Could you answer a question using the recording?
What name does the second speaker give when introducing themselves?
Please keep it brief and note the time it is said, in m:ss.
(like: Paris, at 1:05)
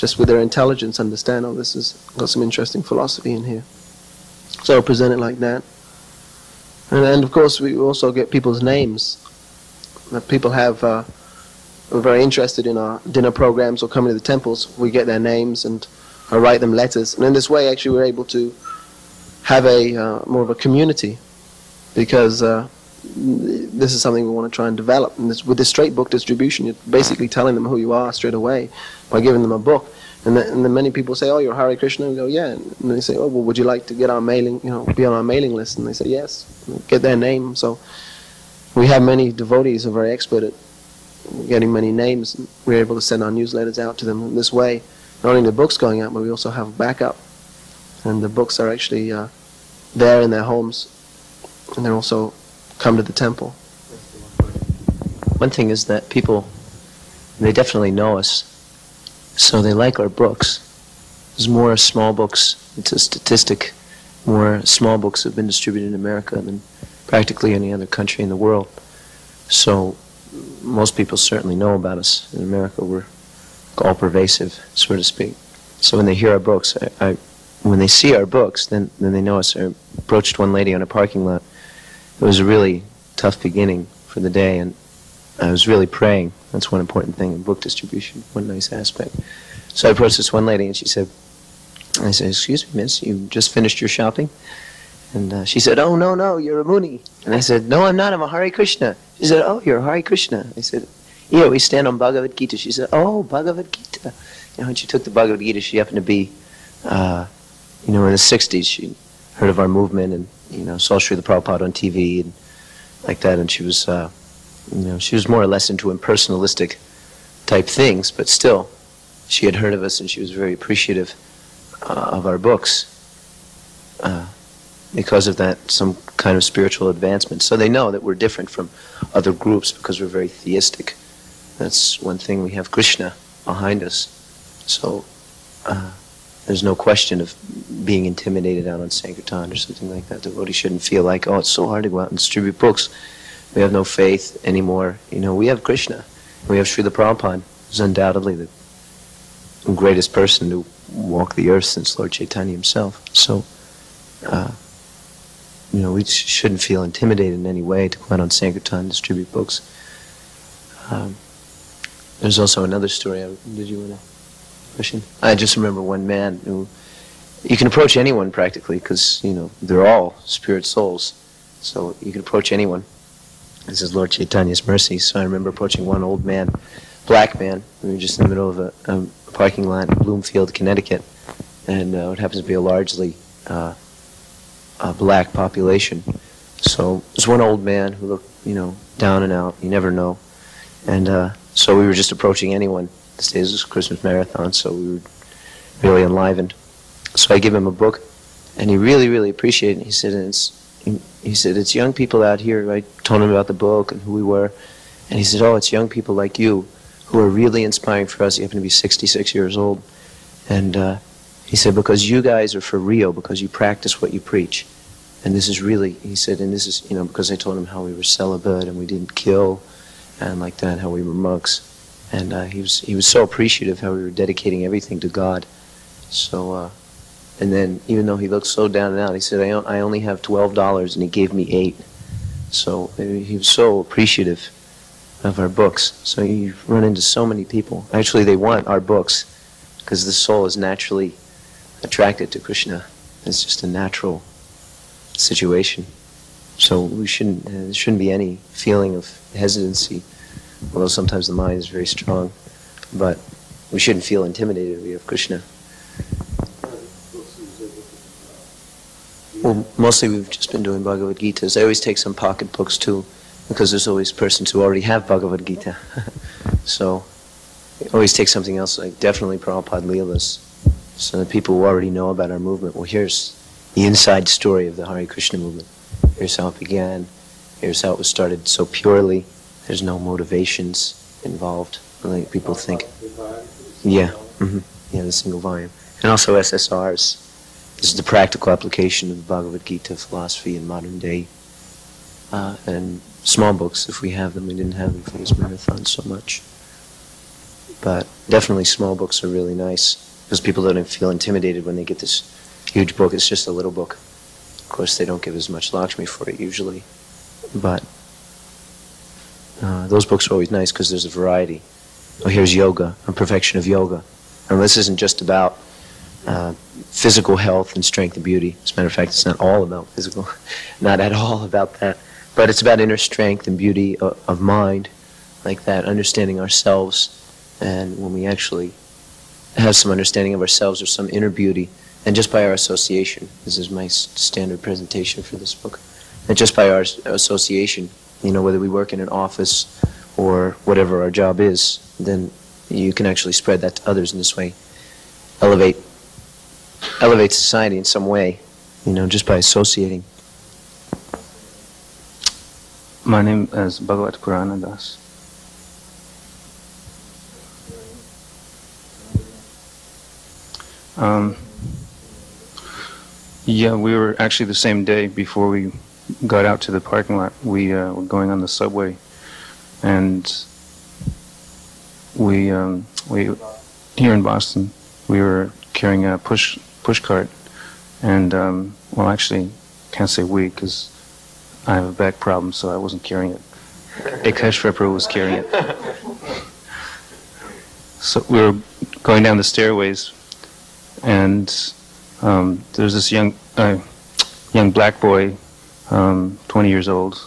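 Bhagwat Puranadas, at 5:53.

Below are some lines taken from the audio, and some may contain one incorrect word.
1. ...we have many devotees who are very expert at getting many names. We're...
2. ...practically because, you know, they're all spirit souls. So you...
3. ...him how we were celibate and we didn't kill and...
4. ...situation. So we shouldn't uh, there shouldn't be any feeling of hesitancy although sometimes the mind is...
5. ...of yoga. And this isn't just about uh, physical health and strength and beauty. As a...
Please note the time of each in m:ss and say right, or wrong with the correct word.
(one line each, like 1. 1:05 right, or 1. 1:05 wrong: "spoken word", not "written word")
1. 0:38 right
2. 2:48 right
3. 3:37 right
4. 4:05 right
5. 5:13 right.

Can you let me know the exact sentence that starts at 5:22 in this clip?
But it's about inner strength and beauty of, uh, of mind, like that, understanding ourselves.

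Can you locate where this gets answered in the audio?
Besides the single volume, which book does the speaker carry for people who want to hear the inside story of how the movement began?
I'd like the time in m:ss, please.
4:29.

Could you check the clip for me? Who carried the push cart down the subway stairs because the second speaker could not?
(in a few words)
Akeshwar Prabhu.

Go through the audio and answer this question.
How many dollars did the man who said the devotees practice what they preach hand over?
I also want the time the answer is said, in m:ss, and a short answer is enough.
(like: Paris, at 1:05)
8, at 3:51.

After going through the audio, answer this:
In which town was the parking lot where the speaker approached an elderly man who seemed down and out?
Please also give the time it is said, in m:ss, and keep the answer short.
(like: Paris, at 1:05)
Bloomfield, Connecticut, at 2:59.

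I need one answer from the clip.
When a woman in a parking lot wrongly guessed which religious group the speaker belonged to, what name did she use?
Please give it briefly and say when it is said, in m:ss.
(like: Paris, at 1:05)
Moonie, at 1:36.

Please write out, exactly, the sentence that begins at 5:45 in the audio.
Elevate, elevate society in some way, you know, just by associating.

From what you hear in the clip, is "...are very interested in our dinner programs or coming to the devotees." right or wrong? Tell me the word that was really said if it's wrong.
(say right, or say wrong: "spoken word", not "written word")
wrong: "temples", not "devotees".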